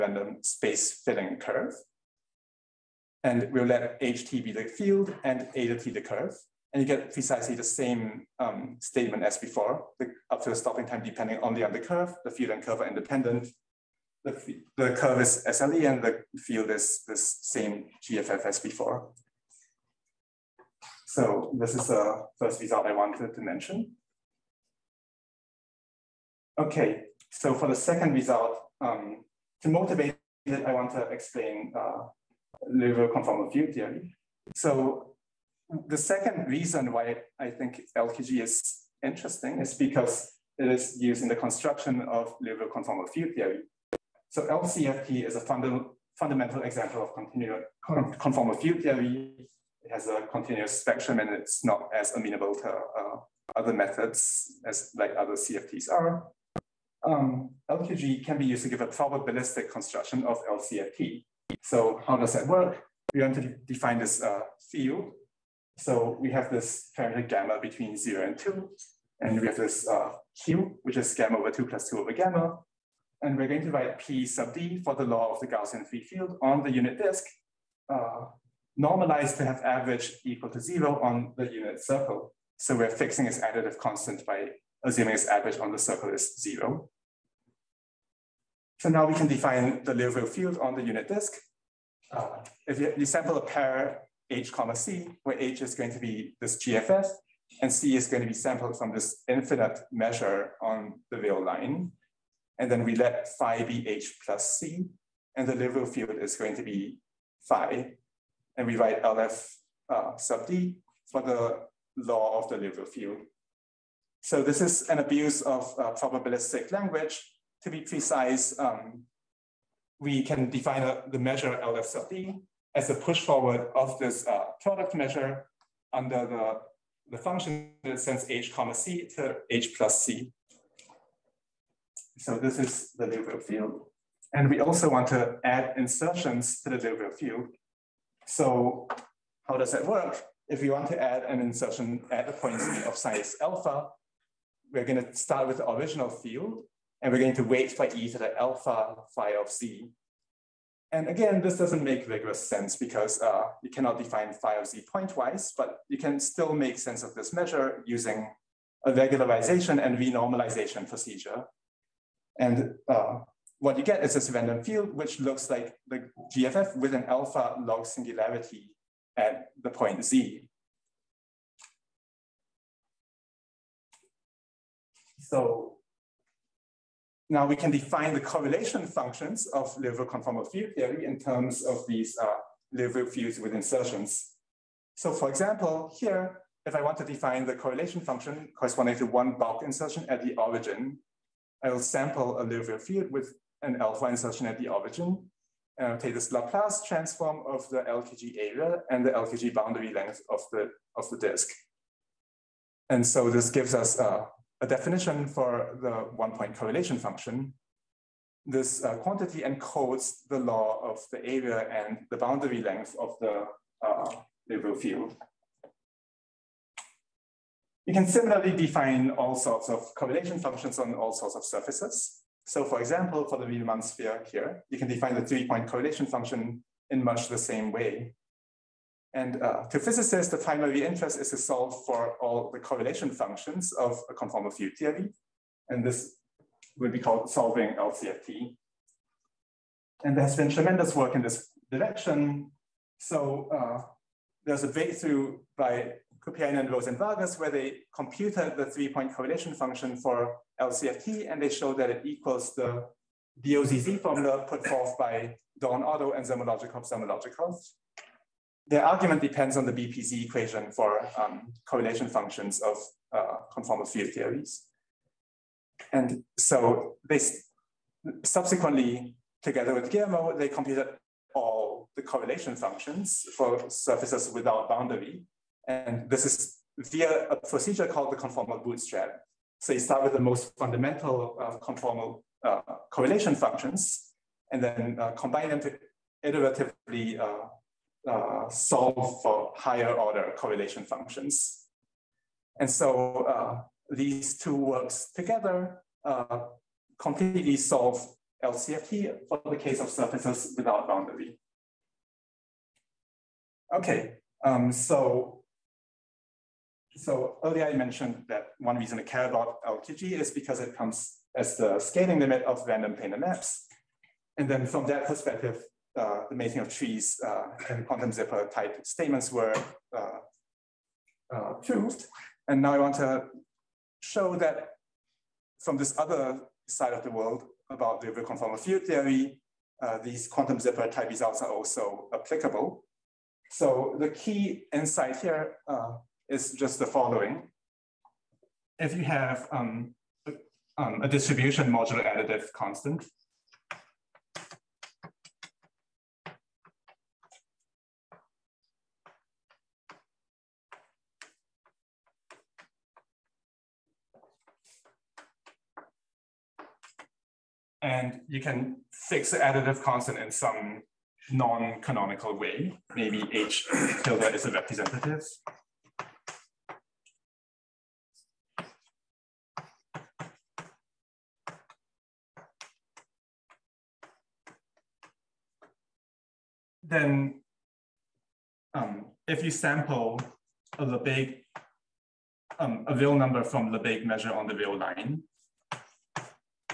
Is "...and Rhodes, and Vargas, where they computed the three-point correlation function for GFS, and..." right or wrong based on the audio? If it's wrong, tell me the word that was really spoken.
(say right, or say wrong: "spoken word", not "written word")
wrong: "LCFT", not "GFS".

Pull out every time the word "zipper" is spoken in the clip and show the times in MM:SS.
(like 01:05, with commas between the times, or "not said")
05:18, 05:30.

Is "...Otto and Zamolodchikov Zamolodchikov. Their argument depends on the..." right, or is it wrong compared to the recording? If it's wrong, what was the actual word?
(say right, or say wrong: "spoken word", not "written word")
right.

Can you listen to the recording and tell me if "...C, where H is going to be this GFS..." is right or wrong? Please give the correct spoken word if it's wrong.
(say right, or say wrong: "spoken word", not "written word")
right.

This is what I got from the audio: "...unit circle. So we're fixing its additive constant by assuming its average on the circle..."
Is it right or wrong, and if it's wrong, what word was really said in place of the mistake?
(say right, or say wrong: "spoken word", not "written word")
right.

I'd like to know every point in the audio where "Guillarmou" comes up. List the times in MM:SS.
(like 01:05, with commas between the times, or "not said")
04:29.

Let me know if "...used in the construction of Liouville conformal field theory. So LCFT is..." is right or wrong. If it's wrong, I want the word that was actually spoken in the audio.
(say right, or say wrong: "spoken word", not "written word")
right.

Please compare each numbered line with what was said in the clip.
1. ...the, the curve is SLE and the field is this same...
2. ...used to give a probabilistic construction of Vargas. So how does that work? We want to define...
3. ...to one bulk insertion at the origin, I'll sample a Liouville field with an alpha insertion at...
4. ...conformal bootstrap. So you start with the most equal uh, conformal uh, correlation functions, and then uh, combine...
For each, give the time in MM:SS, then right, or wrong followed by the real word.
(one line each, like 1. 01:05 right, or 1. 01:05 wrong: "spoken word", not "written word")
1. 00:14 right
2. 00:58 wrong: "LCFT", not "Vargas"
3. 03:08 right
4. 04:38 wrong: "fundamental", not "equal".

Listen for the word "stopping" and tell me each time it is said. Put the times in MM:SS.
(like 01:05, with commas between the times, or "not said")
00:10.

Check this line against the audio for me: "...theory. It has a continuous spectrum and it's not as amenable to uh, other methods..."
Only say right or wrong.
right.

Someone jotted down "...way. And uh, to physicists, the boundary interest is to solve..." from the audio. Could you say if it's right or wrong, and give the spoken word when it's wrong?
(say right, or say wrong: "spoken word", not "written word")
wrong: "primary", not "boundary".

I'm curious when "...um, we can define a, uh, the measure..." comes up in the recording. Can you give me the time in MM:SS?
01:58.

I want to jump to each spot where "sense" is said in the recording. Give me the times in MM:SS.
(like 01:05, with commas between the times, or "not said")
02:32, 02:36.